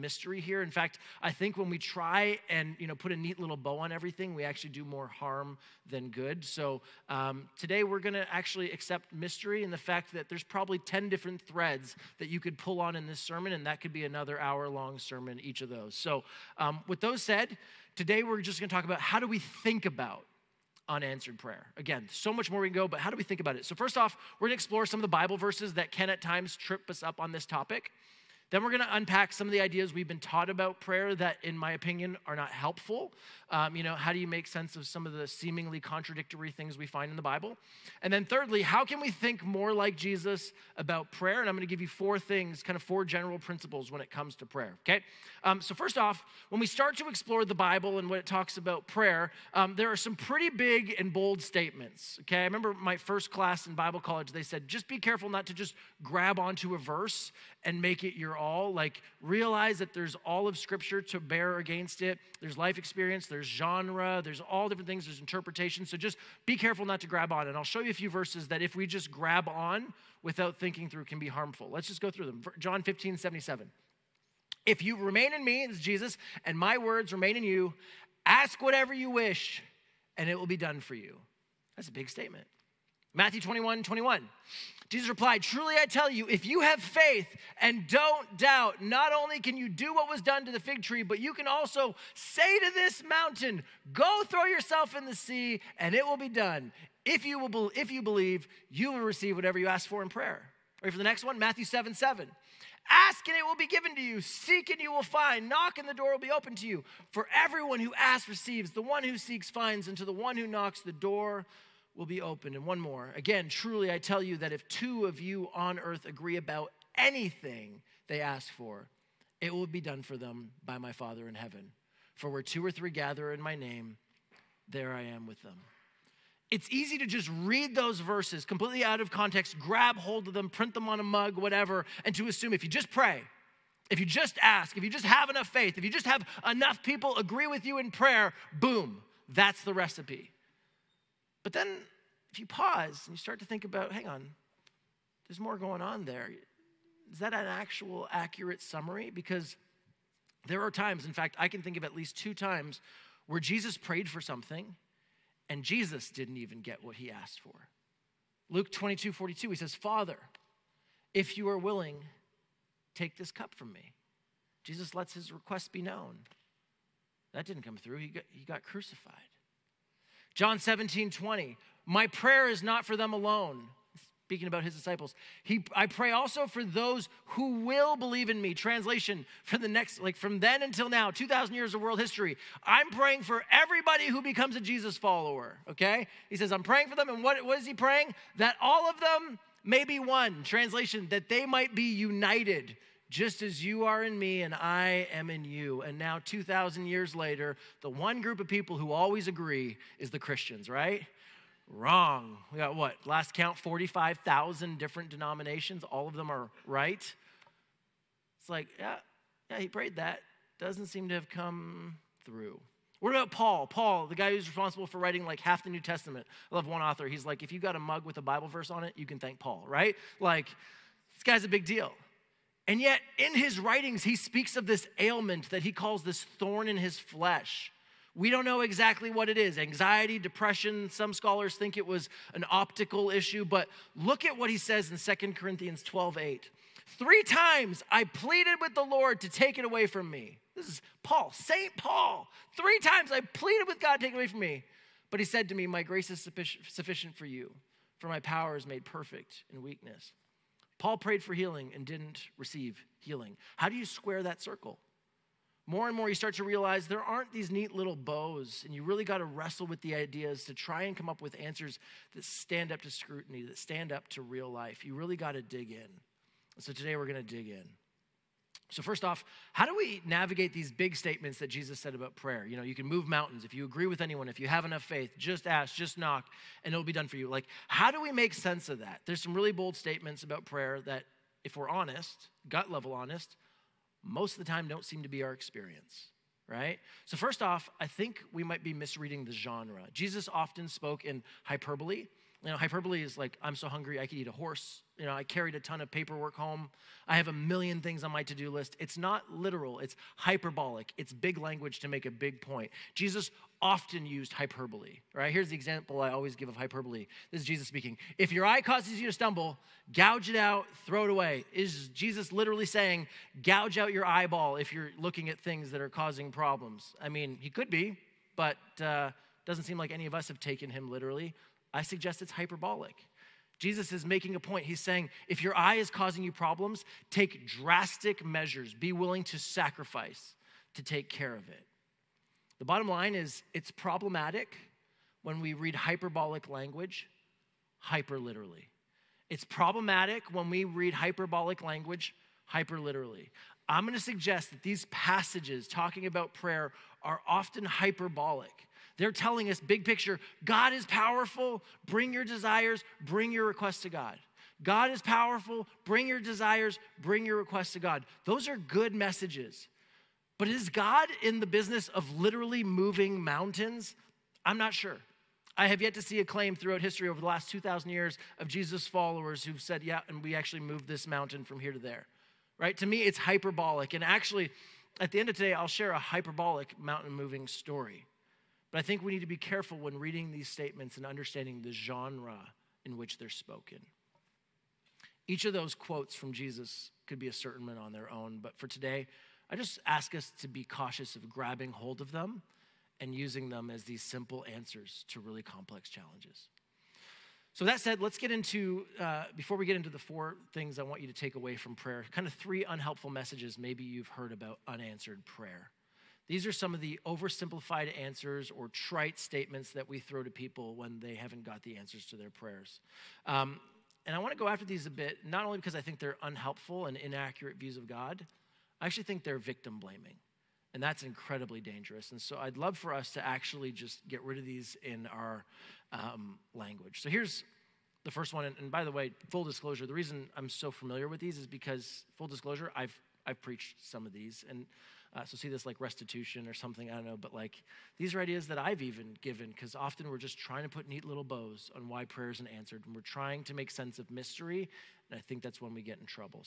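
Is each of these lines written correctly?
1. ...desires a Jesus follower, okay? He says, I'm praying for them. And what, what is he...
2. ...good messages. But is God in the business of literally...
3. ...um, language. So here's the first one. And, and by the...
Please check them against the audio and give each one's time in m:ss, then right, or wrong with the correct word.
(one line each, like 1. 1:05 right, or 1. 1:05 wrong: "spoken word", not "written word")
1. 3:04 wrong: "becomes", not "desires"
2. 5:58 right
3. 7:05 right.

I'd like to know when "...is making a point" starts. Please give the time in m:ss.
5:23.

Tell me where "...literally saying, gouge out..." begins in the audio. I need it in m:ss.
5:12.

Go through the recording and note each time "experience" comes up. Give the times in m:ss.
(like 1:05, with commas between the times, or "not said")
1:02, 4:45.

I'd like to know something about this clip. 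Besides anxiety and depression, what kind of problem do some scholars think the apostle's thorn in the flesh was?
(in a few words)
An optical issue.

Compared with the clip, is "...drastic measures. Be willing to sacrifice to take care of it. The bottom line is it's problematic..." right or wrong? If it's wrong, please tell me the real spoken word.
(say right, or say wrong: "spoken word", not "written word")
right.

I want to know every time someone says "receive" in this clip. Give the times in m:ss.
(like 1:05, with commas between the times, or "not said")
1:39, 1:48, 4:12.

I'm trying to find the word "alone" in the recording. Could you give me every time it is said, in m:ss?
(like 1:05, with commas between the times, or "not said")
2:53.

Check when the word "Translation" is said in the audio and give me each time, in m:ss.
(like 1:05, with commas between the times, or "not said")
2:58, 3:10.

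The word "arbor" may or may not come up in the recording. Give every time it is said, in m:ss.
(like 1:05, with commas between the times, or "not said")
not said.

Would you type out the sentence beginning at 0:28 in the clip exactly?
Then we're going to unpack some of the ideas we've been taught about prayer that, in my opinion, are not helpful.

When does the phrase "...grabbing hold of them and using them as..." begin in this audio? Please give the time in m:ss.
6:31.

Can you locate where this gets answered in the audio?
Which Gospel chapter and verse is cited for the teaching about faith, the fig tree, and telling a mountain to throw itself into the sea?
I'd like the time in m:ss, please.
1:23.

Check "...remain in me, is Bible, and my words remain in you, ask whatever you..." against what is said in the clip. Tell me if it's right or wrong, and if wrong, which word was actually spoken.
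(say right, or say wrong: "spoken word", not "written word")
wrong: "Jesus", not "Bible".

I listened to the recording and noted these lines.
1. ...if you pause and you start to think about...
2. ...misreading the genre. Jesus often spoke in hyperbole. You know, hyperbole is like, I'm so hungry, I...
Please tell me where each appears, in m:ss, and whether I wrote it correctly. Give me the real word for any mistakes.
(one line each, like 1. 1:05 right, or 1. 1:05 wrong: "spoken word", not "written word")
1. 2:22 right
2. 4:48 right.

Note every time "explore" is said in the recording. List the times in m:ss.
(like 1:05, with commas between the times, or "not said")
0:24, 0:47.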